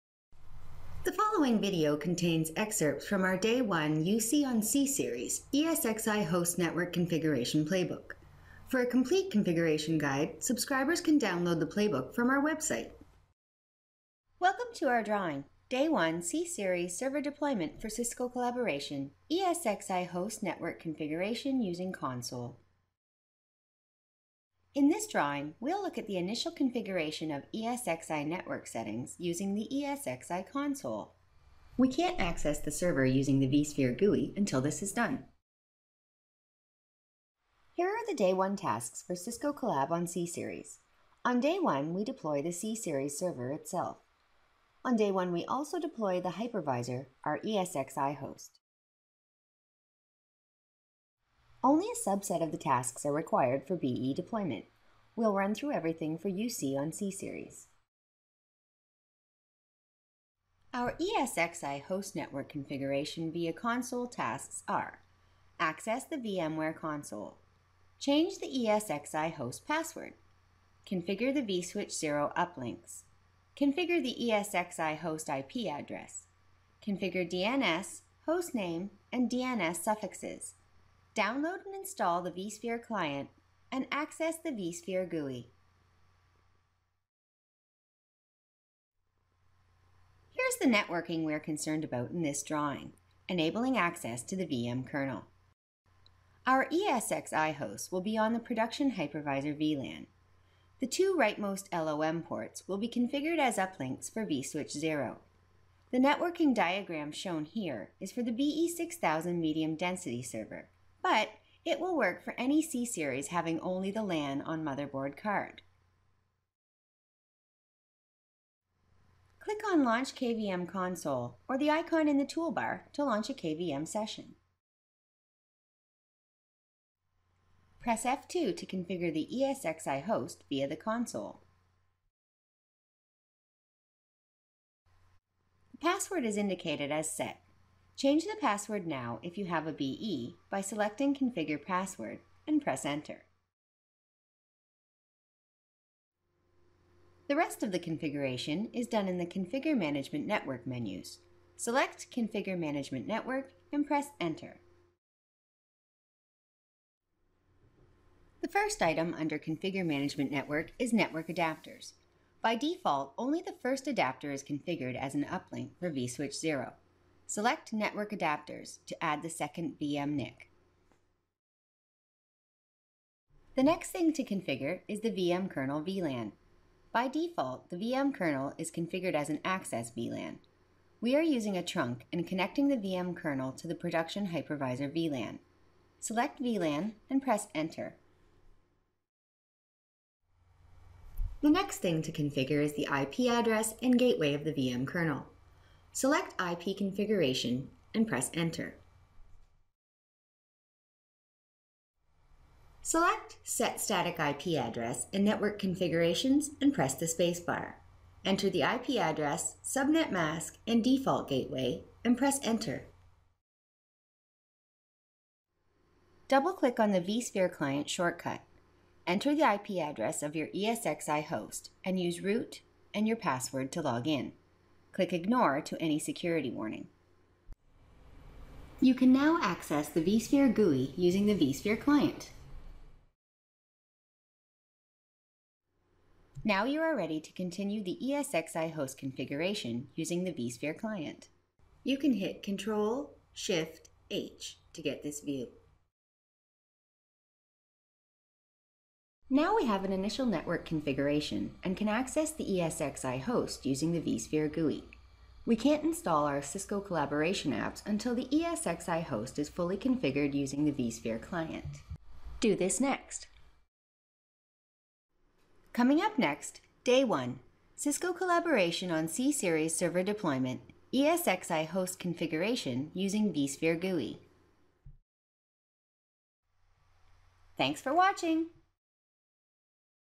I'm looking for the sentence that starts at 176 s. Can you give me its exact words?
By default, the VM kernel is configured as an access VLAN.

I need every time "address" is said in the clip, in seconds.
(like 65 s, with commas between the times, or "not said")
75 s, 193 s, 204 s, 208 s, 219 s.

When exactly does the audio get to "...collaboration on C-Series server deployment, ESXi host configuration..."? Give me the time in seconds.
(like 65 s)
268 s.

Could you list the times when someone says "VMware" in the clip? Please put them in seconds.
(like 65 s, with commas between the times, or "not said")
66 s.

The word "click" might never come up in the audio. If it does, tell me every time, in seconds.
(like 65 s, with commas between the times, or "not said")
119 s, 216 s, 224 s.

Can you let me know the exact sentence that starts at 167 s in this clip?
Select network adapters to add the second VM NIC.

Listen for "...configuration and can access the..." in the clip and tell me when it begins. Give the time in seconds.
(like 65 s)
250 s.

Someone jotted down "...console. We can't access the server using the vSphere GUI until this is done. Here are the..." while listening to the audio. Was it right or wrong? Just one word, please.
right.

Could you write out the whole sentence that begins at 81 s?
Download and install the vSphere client and access the vSphere GUI.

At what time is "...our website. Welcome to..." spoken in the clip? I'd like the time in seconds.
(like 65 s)
12 s.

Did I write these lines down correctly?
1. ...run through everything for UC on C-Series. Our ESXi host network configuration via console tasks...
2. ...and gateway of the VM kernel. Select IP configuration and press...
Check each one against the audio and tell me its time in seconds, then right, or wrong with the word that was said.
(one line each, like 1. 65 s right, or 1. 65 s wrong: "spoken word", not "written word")
1. 55 s right
2. 193 s right.